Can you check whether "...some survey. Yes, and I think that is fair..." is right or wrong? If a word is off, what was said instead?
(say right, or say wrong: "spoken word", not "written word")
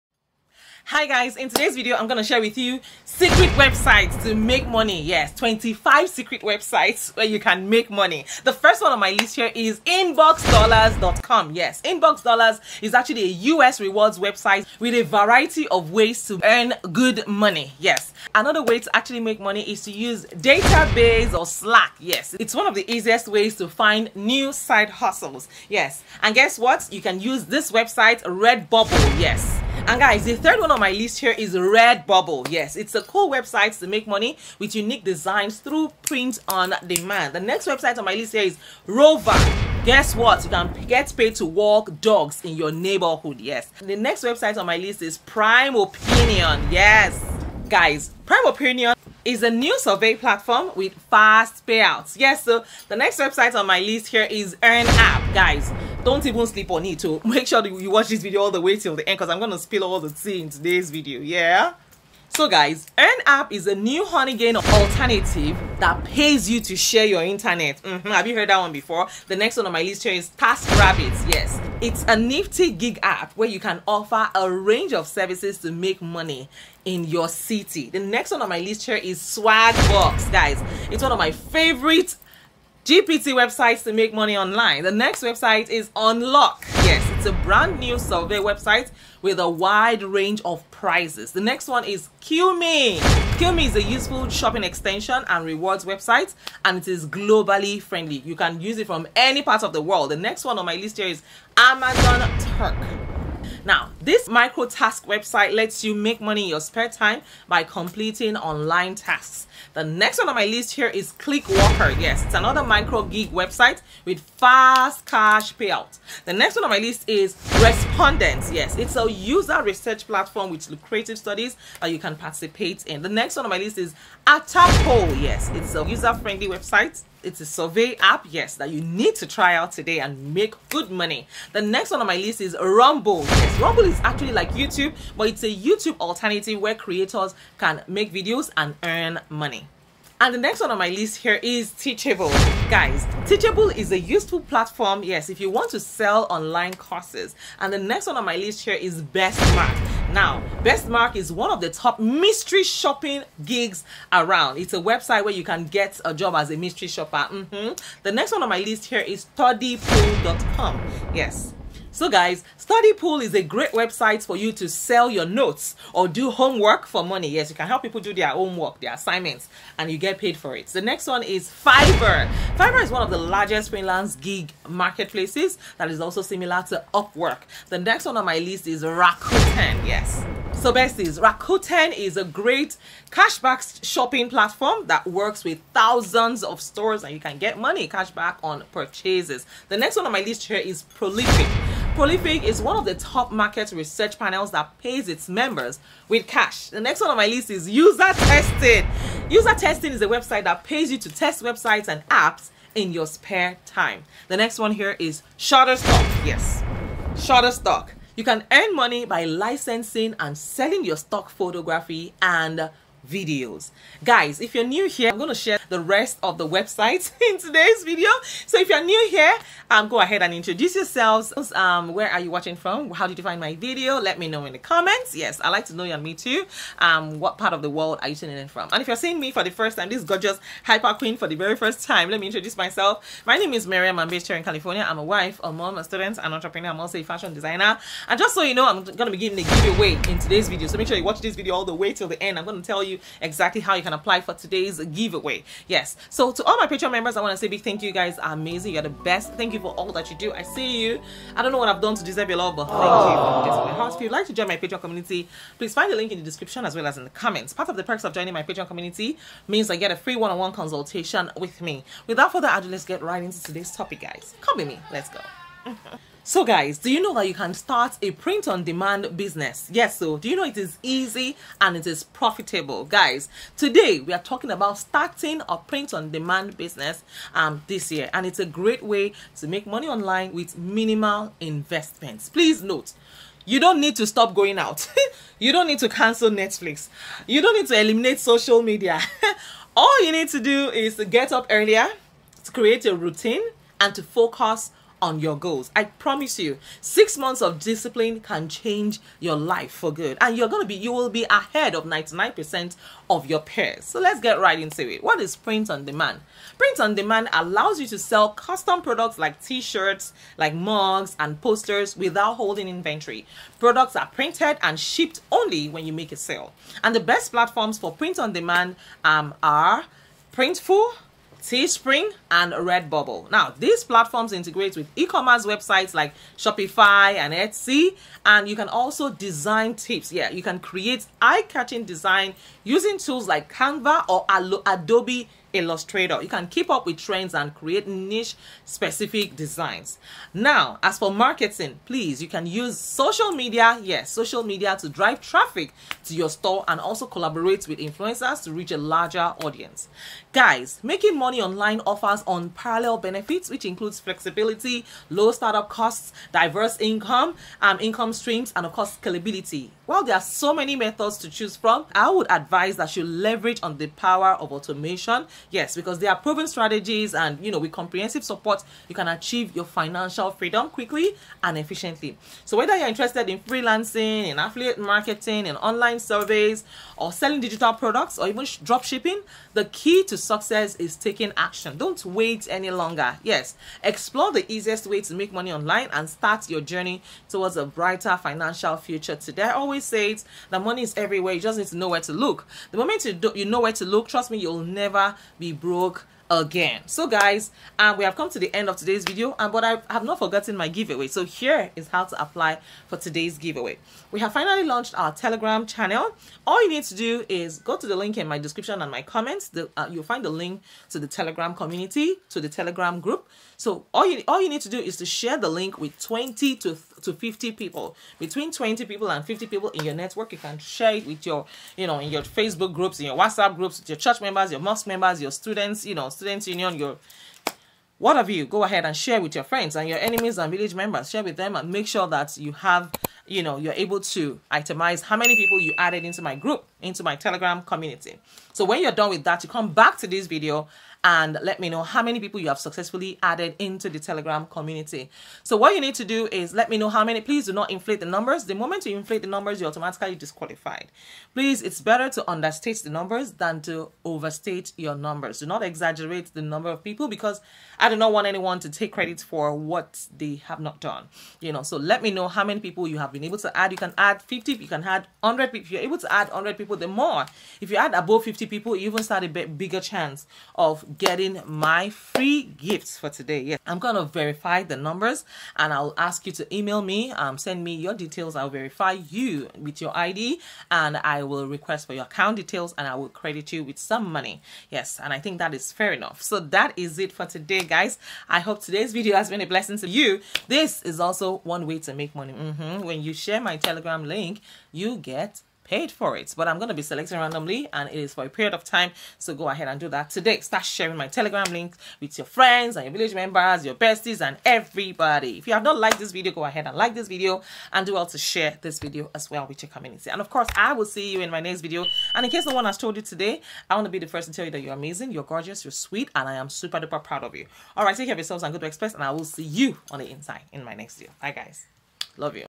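wrong: "money", not "survey".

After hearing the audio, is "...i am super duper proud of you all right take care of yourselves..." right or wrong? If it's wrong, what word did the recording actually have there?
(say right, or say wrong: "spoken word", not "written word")
right.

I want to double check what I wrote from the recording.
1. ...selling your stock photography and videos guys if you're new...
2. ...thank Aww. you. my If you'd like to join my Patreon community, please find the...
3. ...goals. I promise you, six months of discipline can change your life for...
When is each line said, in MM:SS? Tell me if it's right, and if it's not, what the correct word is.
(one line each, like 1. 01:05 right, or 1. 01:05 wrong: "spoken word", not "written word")
1. 03:30 right
2. 04:12 right
3. 04:55 right.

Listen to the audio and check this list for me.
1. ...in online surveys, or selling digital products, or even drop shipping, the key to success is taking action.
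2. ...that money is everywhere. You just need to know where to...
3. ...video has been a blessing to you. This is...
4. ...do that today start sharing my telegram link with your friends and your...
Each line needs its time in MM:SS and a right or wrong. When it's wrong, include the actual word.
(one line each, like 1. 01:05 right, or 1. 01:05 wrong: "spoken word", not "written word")
1. 06:15 right
2. 06:30 right
3. 08:08 right
4. 08:19 right.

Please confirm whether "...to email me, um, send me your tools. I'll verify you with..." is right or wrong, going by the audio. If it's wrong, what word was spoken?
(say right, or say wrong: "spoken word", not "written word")
wrong: "details", not "tools".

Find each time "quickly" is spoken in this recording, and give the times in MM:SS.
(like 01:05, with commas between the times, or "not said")
06:10.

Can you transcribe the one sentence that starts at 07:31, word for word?
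Please, it's better to understate the numbers than to overstate your numbers.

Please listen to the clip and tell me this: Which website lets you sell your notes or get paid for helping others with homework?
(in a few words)
StudyPool.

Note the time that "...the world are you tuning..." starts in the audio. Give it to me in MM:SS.
03:47.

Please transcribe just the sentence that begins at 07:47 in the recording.
If you add above 50 people, you even start a bigger chance of getting my free gifts for today.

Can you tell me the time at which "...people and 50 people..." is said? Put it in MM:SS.
06:58.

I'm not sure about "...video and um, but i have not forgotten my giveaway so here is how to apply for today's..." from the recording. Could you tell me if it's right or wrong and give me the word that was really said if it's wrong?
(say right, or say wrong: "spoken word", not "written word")
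right.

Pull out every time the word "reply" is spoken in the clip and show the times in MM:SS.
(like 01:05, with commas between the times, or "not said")
not said.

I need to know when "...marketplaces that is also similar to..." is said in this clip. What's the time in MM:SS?
02:54.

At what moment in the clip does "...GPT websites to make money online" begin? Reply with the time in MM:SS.
01:22.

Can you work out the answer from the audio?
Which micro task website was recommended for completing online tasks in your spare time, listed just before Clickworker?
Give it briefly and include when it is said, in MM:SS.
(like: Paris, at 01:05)
Amazon Turk, at 01:41.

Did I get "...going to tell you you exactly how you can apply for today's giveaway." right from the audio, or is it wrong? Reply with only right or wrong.
right.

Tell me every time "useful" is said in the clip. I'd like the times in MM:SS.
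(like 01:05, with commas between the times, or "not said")
01:33, 02:23.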